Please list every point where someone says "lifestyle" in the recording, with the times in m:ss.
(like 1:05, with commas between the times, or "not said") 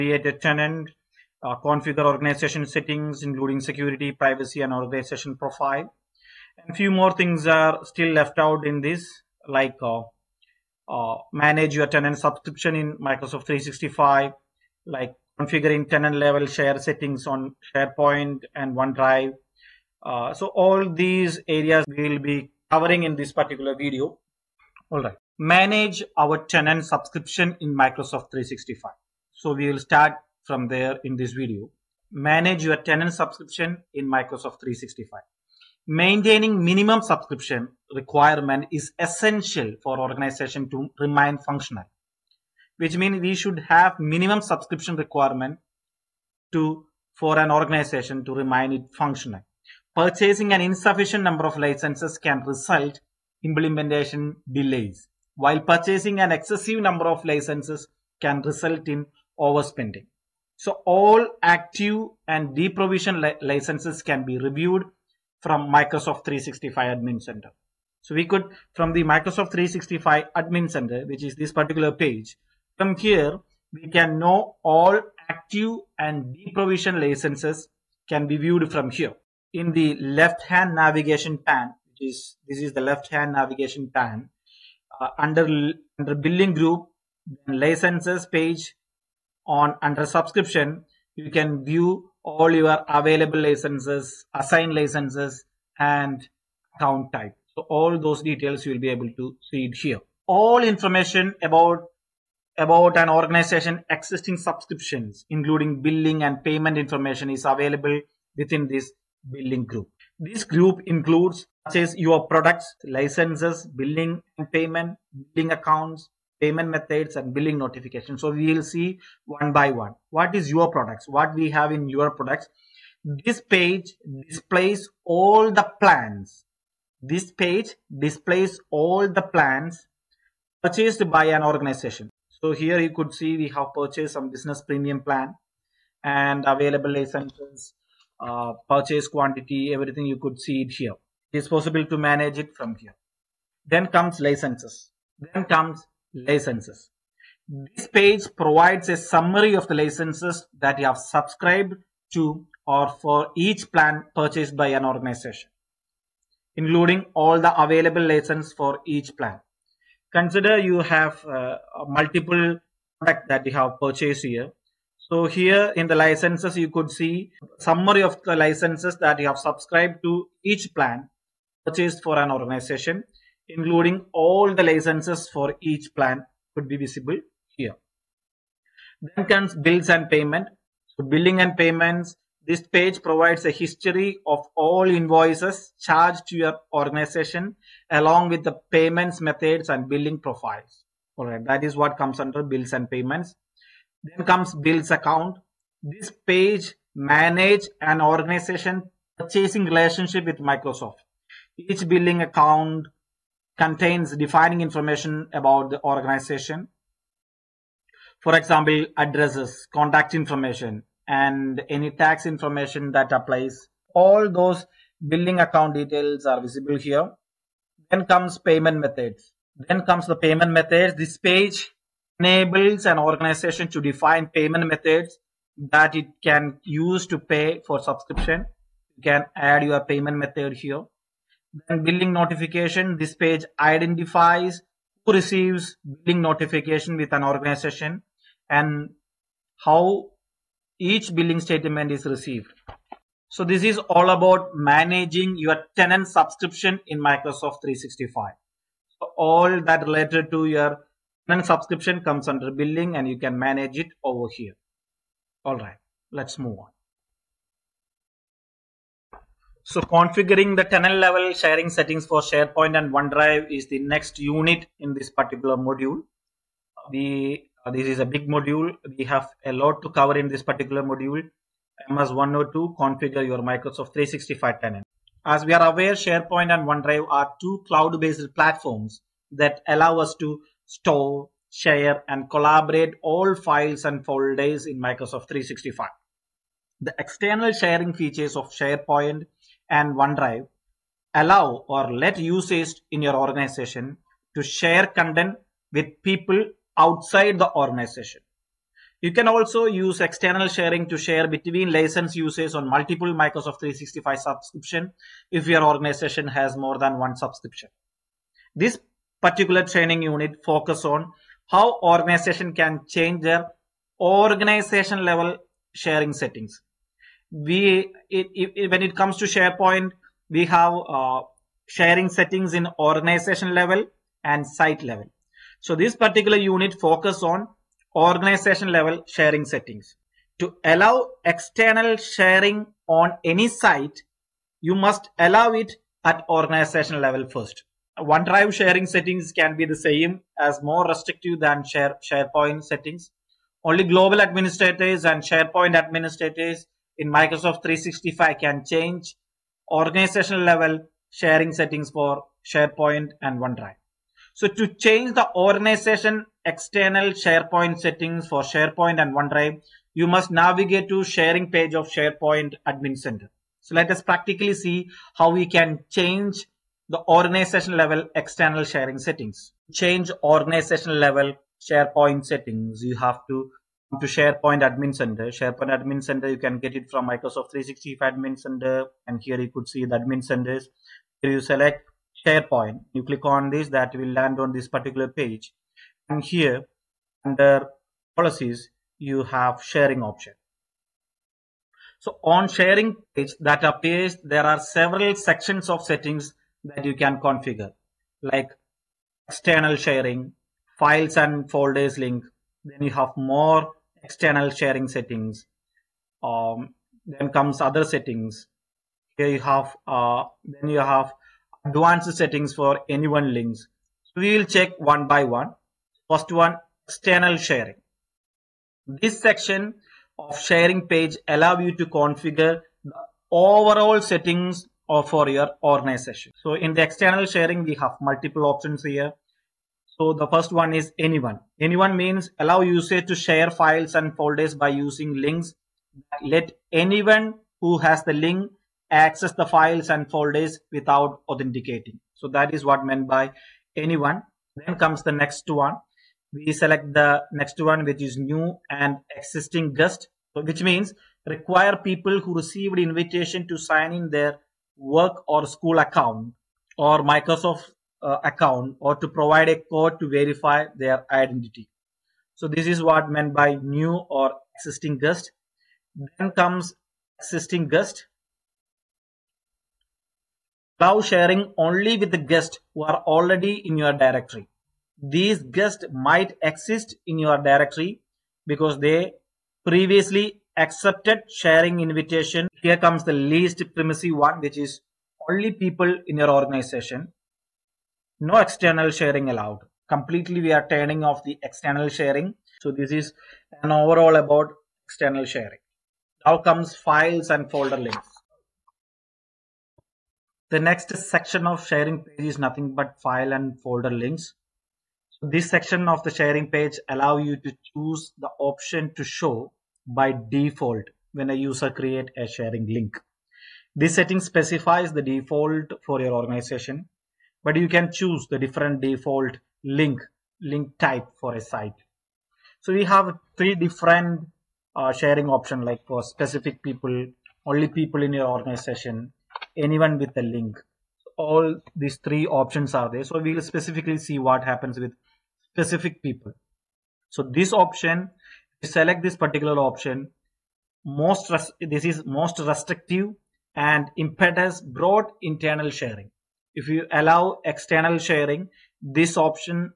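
not said.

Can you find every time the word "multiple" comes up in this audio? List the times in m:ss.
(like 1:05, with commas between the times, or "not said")
2:41, 5:02, 7:08.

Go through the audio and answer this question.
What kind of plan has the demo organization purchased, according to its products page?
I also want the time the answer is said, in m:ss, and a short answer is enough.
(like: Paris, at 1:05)
Business premium, at 2:14.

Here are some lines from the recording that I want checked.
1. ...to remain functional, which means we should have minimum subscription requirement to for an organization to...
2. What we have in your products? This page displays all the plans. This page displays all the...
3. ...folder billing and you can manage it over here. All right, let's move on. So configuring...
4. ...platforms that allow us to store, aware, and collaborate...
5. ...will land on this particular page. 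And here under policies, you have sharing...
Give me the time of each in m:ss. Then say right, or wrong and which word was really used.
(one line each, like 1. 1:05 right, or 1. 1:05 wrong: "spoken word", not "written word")
1. 0:40 right
2. 2:01 right
3. 4:12 wrong: "under", not "folder"
4. 4:38 wrong: "share", not "aware"
5. 6:23 right.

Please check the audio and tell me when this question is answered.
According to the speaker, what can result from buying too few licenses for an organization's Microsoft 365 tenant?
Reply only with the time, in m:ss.
0:53.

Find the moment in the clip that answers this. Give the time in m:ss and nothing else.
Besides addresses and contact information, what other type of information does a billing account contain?
3:32.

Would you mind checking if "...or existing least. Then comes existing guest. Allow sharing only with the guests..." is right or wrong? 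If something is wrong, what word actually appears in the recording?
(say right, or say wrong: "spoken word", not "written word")
wrong: "guest", not "least".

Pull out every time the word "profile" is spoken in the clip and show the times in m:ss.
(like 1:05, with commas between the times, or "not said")
0:05, 3:10.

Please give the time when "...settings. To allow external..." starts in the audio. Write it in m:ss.
5:29.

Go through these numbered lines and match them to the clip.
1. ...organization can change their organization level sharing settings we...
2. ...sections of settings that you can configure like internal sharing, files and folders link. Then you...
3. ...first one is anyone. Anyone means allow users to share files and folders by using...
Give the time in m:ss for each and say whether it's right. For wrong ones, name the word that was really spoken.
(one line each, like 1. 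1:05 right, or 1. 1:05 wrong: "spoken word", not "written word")
1. 5:11 right
2. 6:35 wrong: "external", not "internal"
3. 7:10 right.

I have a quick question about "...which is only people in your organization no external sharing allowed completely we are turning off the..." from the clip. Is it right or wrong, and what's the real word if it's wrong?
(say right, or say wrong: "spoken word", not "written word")
right.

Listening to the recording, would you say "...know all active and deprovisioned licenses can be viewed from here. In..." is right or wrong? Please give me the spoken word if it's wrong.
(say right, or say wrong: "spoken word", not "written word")
right.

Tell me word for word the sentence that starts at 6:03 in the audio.
So let us practically see how we can change the organization level external sharing settings.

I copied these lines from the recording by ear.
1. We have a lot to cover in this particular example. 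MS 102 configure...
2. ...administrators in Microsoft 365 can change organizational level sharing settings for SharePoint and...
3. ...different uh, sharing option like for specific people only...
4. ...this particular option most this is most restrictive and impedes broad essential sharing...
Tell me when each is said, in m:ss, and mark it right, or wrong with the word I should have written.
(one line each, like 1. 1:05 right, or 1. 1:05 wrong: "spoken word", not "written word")
1. 4:28 wrong: "module", not "example"
2. 5:45 right
3. 8:43 right
4. 8:59 wrong: "internal", not "essential".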